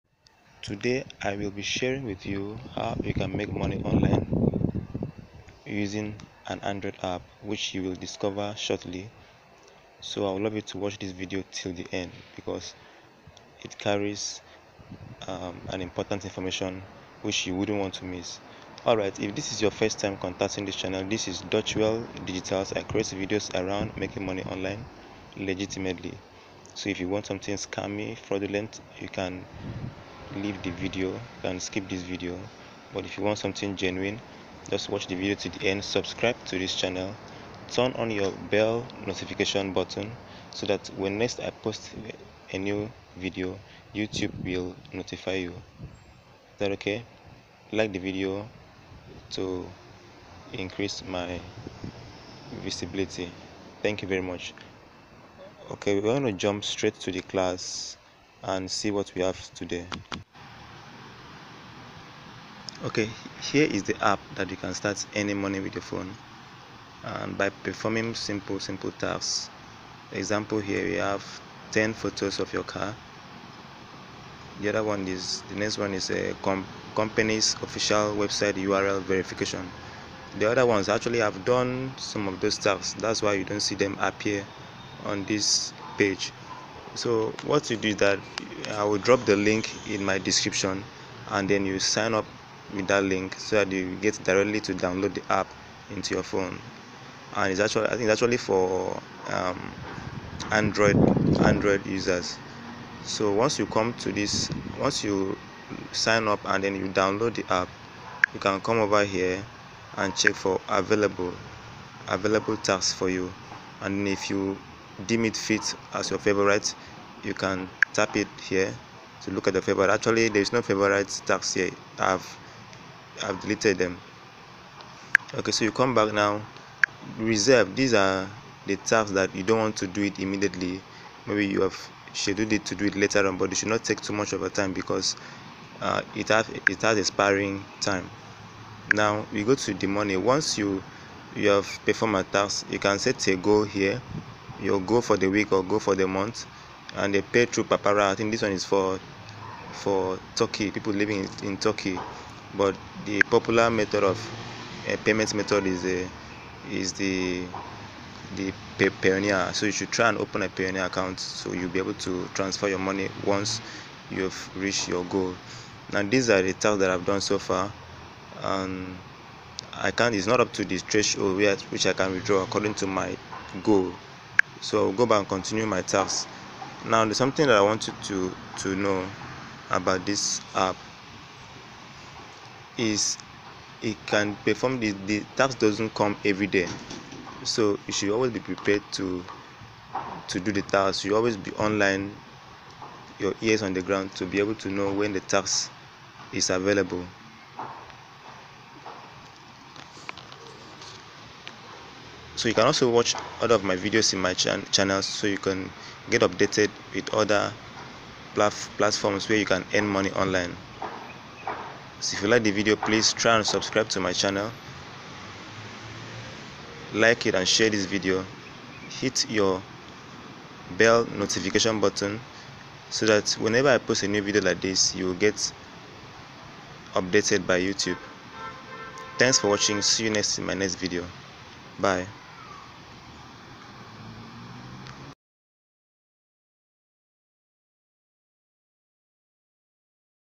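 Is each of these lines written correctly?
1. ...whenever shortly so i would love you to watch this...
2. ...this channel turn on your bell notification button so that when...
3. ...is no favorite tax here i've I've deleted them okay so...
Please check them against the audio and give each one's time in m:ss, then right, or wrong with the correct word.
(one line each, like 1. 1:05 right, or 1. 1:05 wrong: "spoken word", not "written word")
1. 0:07 wrong: "discover", not "whenever"
2. 0:36 right
3. 2:00 right.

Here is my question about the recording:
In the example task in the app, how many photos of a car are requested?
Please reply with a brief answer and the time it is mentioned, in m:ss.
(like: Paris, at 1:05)
10, at 1:11.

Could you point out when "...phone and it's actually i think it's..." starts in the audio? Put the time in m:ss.
1:36.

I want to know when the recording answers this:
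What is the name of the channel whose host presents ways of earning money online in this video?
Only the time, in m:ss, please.
0:21.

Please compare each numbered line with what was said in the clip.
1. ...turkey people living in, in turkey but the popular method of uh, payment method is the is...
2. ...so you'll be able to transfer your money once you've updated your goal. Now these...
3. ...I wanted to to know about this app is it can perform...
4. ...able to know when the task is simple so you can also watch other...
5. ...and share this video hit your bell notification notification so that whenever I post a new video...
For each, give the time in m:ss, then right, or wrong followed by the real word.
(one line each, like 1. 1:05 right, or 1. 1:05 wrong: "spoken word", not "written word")
1. 2:30 right
2. 2:41 wrong: "reached", not "updated"
3. 2:57 right
4. 3:14 wrong: "available", not "simple"
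5. 3:37 wrong: "button", not "notification".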